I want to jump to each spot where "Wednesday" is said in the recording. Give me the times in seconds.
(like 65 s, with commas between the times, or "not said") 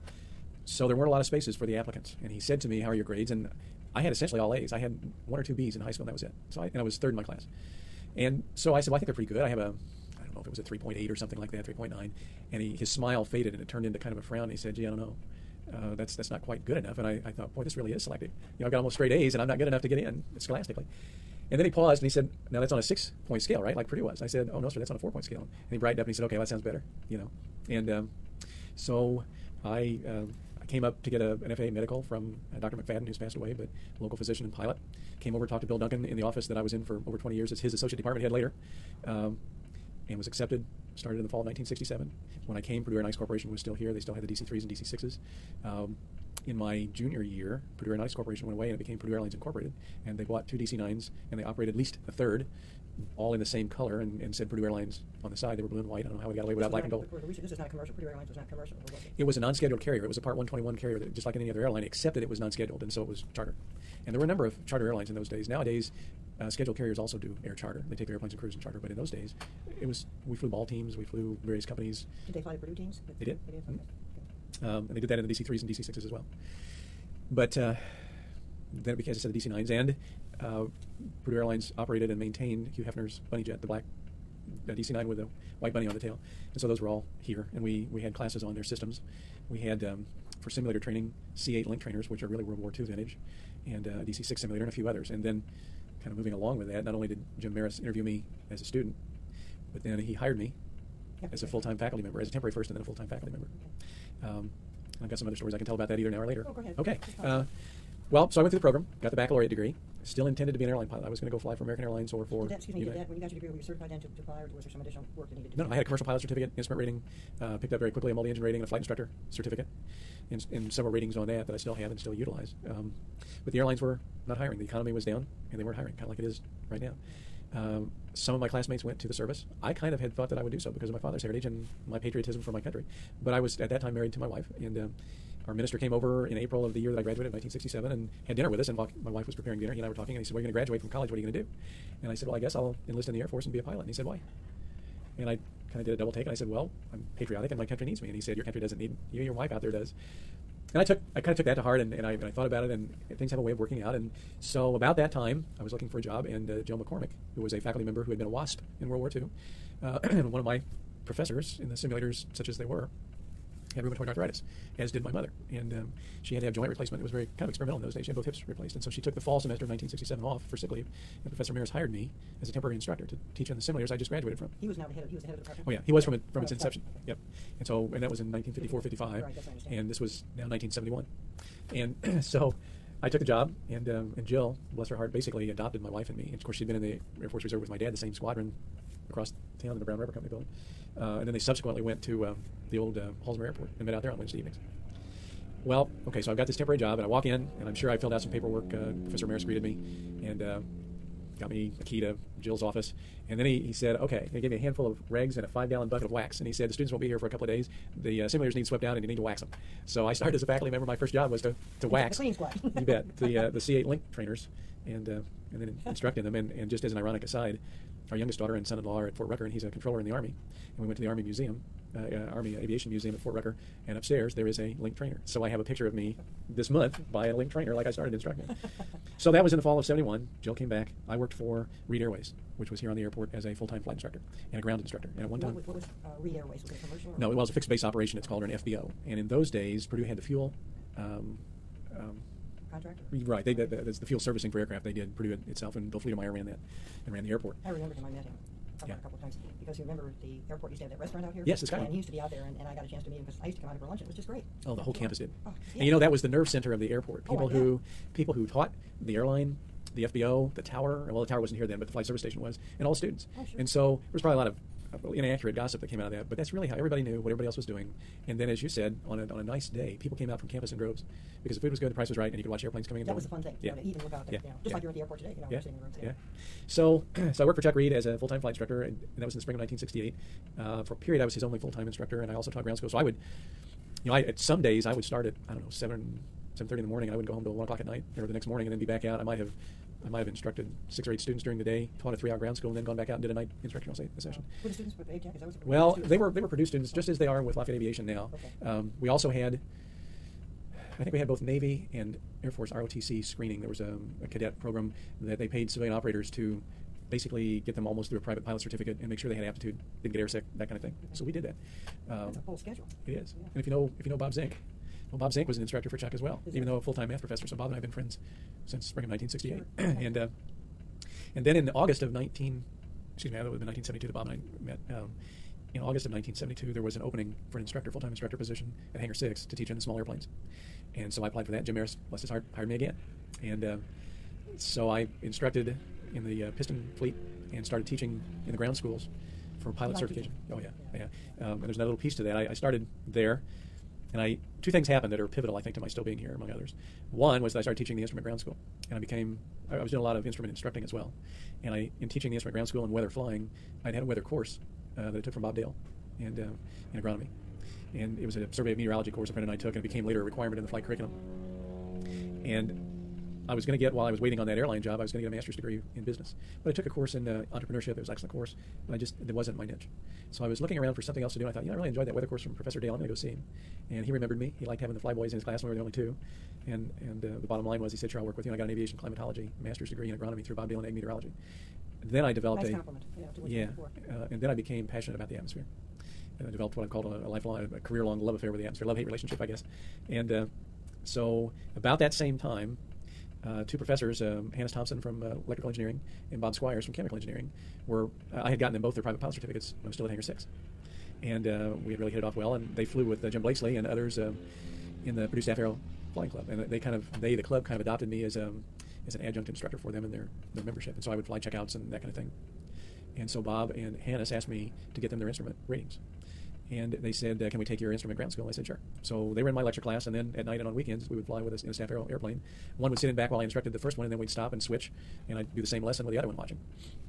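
194 s.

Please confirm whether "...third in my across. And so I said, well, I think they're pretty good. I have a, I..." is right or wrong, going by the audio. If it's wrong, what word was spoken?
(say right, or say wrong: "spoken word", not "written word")
wrong: "class", not "across".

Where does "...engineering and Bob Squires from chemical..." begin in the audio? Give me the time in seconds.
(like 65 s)
395 s.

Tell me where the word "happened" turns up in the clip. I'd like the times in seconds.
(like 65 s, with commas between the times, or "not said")
344 s.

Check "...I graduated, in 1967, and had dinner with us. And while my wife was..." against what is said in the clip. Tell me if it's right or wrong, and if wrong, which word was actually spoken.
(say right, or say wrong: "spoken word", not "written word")
right.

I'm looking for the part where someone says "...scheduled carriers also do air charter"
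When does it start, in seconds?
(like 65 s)
66 s.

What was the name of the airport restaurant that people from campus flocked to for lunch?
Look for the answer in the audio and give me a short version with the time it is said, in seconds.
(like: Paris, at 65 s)
Skyline, at 251 s.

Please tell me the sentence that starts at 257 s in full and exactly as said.
Oh, people oh, who, people who taught the airline the FBO, the tower.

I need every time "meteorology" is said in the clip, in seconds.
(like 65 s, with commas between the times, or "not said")
358 s, 380 s.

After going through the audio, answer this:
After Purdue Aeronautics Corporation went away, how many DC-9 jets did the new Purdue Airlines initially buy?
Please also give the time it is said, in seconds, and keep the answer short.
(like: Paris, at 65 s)
2, at 50 s.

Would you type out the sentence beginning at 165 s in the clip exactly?
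And um, she had to have joint replacement.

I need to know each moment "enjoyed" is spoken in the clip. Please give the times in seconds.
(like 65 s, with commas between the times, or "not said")
371 s.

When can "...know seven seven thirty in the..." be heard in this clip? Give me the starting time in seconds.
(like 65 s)
285 s.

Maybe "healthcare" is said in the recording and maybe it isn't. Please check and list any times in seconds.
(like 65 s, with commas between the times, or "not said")
not said.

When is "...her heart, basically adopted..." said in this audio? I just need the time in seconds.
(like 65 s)
184 s.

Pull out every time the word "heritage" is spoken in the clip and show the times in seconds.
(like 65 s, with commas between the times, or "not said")
131 s.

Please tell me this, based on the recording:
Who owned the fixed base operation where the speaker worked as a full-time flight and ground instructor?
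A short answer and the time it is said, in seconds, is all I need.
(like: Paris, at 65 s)
Chuck Reed, at 277 s.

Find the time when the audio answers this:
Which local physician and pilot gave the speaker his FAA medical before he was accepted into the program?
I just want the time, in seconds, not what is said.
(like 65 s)
32 s.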